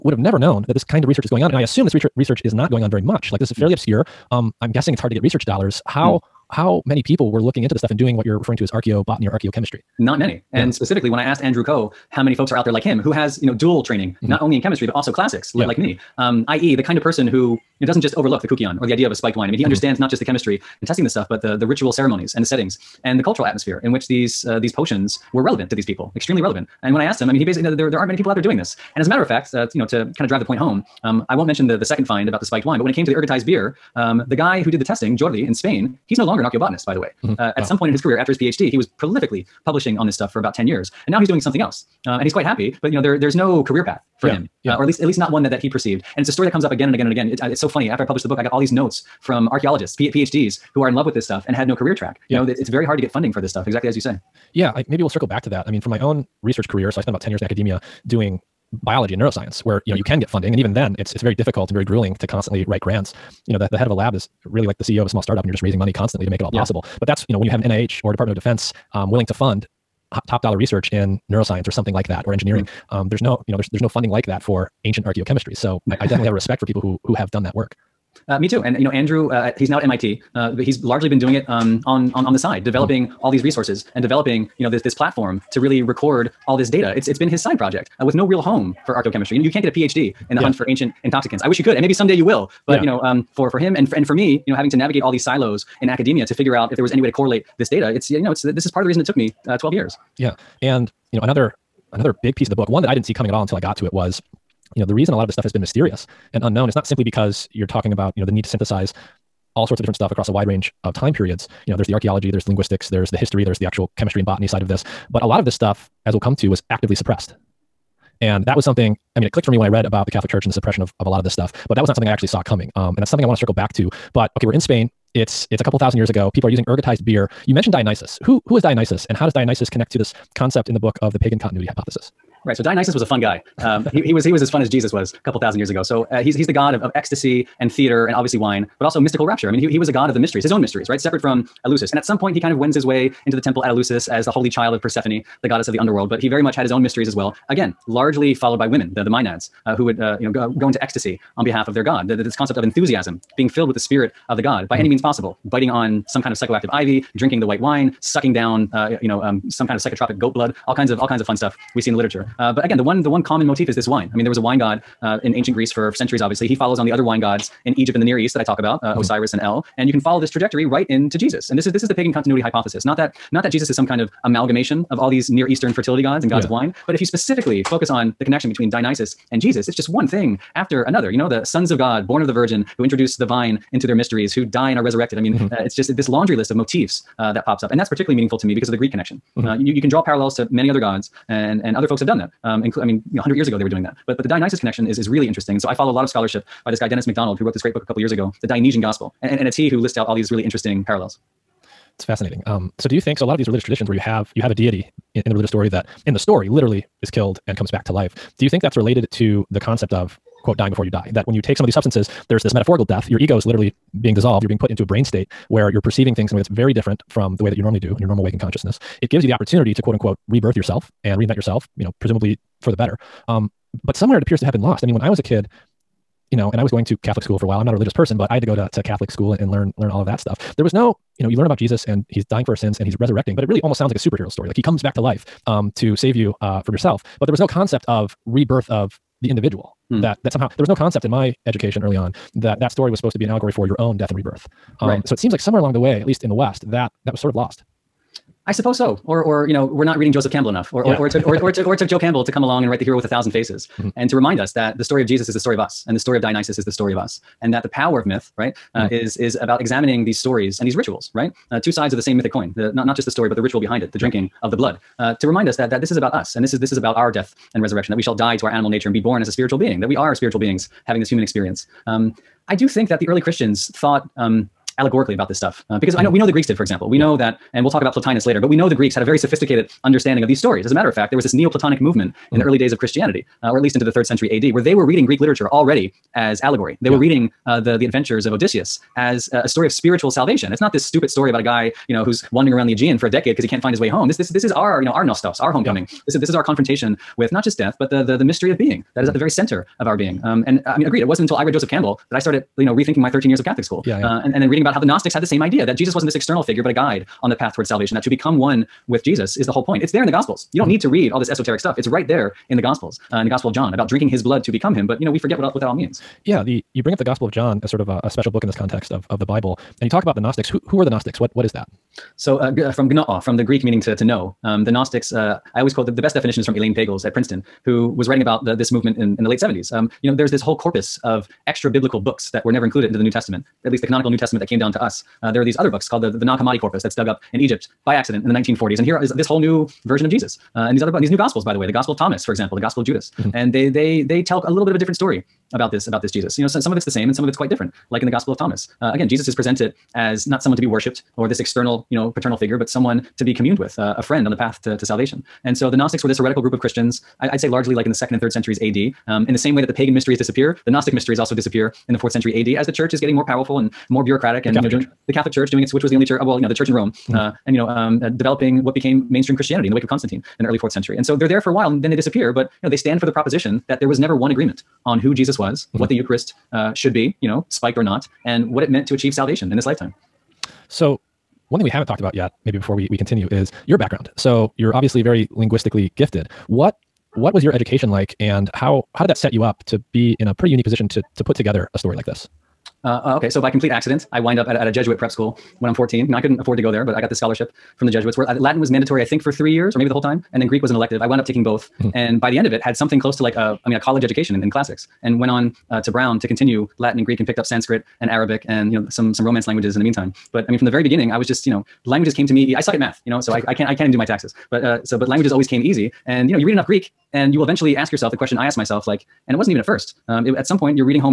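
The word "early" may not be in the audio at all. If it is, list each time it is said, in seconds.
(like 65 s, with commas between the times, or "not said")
241 s, 273 s, 282 s, 370 s.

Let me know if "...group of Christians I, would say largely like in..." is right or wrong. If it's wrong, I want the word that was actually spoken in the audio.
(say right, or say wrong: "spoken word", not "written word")
right.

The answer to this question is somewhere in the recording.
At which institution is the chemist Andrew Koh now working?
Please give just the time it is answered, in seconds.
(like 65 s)
79 s.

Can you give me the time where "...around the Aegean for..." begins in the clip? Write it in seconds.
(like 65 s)
292 s.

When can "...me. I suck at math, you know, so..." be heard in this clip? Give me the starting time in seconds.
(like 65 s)
412 s.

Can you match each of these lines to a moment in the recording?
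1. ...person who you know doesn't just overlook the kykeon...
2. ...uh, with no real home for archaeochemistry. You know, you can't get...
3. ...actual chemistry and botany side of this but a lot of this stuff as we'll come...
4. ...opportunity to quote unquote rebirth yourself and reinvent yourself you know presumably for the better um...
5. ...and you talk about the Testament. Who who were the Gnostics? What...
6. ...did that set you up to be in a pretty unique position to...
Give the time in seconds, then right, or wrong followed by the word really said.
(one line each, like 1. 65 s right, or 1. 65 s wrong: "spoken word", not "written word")
1. 17 s right
2. 88 s right
3. 113 s right
4. 219 s right
5. 319 s wrong: "Gnostics", not "Testament"
6. 389 s right.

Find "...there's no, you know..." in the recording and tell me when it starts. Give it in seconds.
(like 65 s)
73 s.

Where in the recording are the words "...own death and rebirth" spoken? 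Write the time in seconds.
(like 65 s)
243 s.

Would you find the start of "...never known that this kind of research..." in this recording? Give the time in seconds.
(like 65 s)
0 s.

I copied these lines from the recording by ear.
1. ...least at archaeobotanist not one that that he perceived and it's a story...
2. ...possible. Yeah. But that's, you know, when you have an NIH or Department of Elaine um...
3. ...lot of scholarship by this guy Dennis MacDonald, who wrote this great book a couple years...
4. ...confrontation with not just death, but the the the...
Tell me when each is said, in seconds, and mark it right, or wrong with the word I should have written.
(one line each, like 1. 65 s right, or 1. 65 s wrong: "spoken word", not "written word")
1. 44 s wrong: "least", not "archaeobotanist"
2. 66 s wrong: "Defense", not "Elaine"
3. 195 s right
4. 296 s right.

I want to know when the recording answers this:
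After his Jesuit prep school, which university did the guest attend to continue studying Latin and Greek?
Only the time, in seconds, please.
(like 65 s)
405 s.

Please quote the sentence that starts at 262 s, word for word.
The not not just the story, but the ritual behind it, the drinking yeah.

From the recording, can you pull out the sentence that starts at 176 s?
of wine, but if you specifically focus on the connection between Dionysus and Jesus, it's just one thing after another.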